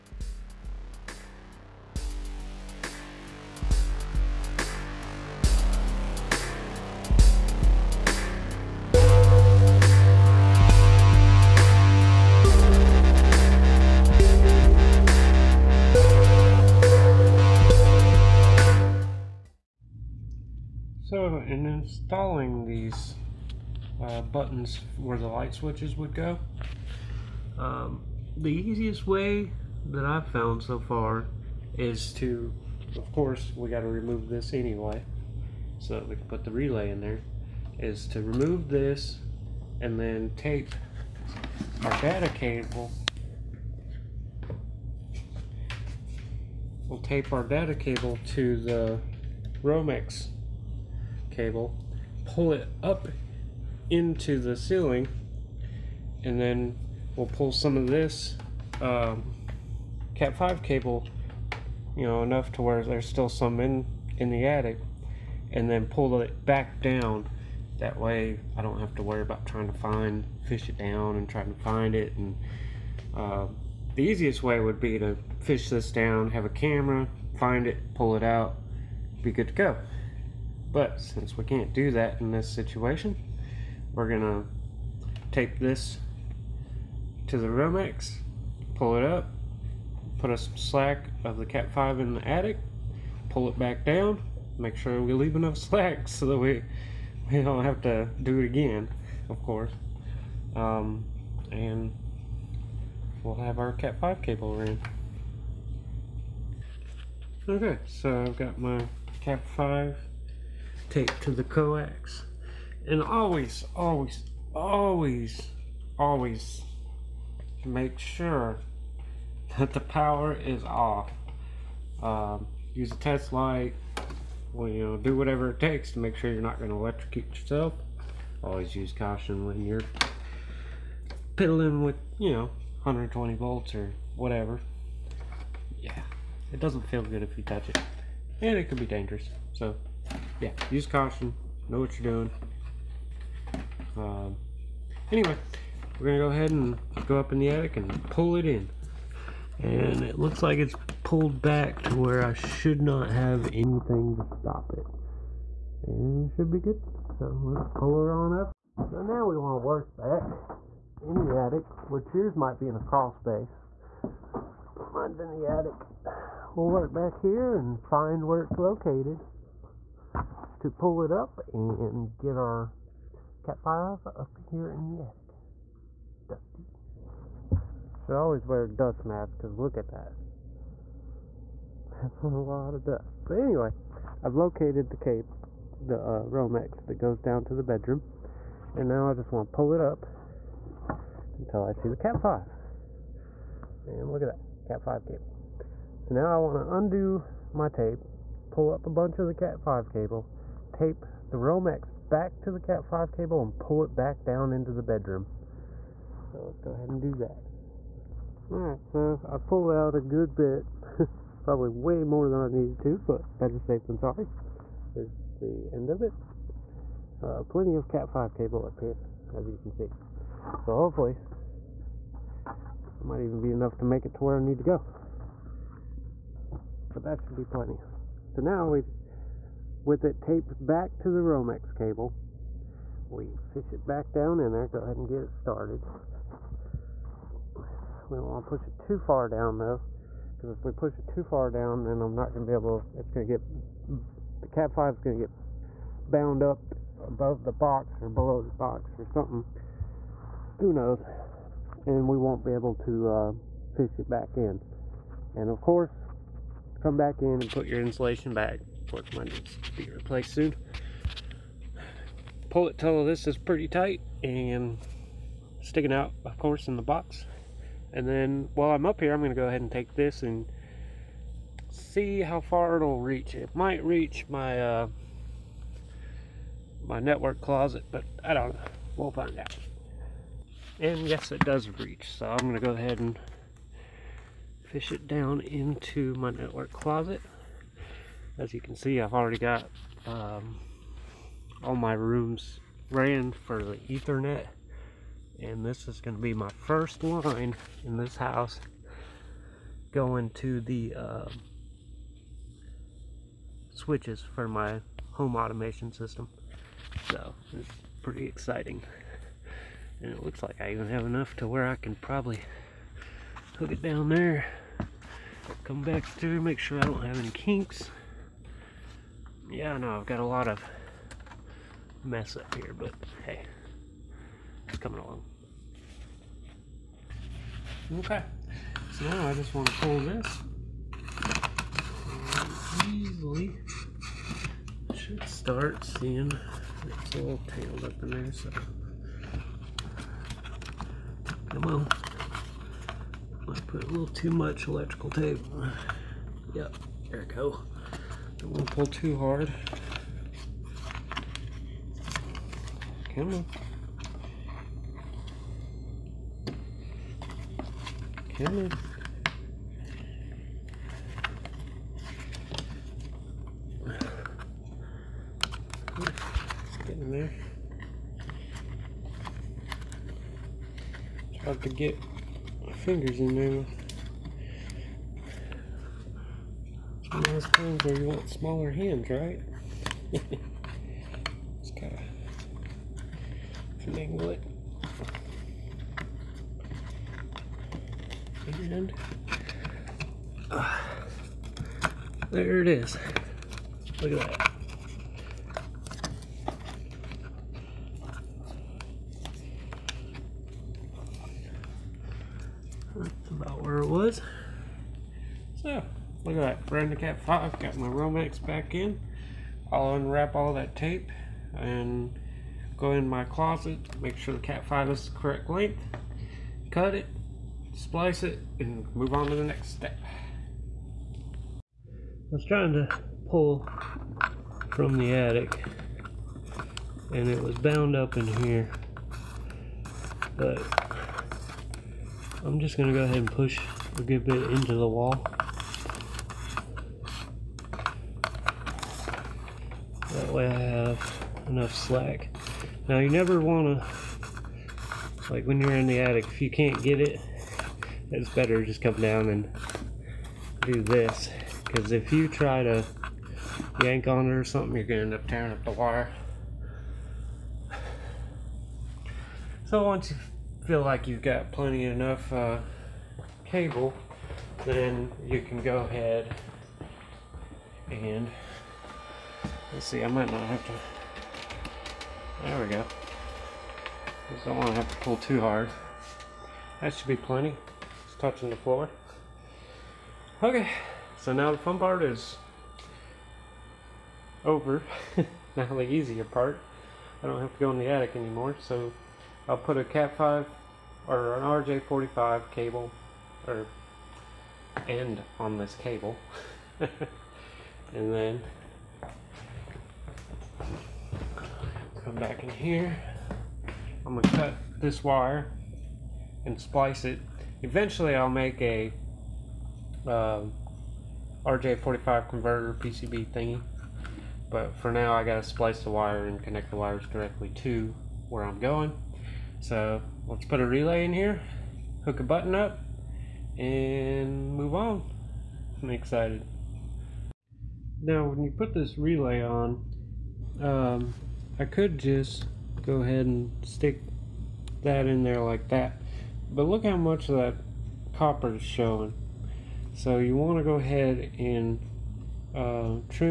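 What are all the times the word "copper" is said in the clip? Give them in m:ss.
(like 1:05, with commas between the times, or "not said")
8:58.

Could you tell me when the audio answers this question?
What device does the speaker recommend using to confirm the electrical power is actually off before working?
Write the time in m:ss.
2:02.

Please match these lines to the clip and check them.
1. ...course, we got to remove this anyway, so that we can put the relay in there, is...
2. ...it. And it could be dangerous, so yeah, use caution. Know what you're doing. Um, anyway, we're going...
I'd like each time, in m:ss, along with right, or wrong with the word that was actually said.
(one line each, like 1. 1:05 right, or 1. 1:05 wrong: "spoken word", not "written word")
1. 0:33 right
2. 2:17 right.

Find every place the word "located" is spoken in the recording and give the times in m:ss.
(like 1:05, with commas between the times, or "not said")
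2:48, 3:04.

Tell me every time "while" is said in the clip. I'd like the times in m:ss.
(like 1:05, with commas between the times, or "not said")
4:28.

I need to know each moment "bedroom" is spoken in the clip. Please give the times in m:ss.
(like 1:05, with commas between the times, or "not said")
3:07, 3:24.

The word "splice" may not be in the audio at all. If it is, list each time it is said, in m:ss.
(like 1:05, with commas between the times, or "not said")
6:57, 8:26, 8:35.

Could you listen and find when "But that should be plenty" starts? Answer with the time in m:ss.
3:46.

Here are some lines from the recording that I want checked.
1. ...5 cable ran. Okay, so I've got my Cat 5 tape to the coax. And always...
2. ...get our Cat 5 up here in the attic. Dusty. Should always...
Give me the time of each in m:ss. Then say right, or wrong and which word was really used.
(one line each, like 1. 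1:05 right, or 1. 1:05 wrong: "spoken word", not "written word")
1. 1:44 right
2. 2:52 right.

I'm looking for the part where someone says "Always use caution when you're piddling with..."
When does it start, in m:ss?
2:08.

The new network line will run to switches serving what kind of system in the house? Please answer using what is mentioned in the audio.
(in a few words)
Home automation system.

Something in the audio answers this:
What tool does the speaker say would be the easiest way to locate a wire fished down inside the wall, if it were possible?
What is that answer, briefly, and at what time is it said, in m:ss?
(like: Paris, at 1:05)
A camera, at 1:16.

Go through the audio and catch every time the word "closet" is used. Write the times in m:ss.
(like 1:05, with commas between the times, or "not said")
4:37, 4:46, 6:53.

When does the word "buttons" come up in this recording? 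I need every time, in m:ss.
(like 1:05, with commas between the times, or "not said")
0:24, 8:42.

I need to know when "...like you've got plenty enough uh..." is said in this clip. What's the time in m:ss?
7:40.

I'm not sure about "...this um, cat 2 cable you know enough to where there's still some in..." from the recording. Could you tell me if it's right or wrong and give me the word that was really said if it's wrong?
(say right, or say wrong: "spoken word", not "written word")
wrong: "5", not "2".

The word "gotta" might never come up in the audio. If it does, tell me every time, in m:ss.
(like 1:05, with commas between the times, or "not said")
6:21, 8:35.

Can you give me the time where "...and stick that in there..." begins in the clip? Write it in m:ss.
8:53.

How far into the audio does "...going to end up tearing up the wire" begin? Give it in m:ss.
7:34.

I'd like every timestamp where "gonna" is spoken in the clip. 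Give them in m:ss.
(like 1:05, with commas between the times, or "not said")
1:24, 8:24.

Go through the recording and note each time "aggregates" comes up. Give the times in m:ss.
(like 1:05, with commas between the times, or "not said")
not said.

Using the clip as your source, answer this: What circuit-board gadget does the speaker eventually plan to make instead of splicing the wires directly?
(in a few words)
RJ45 converter PCB.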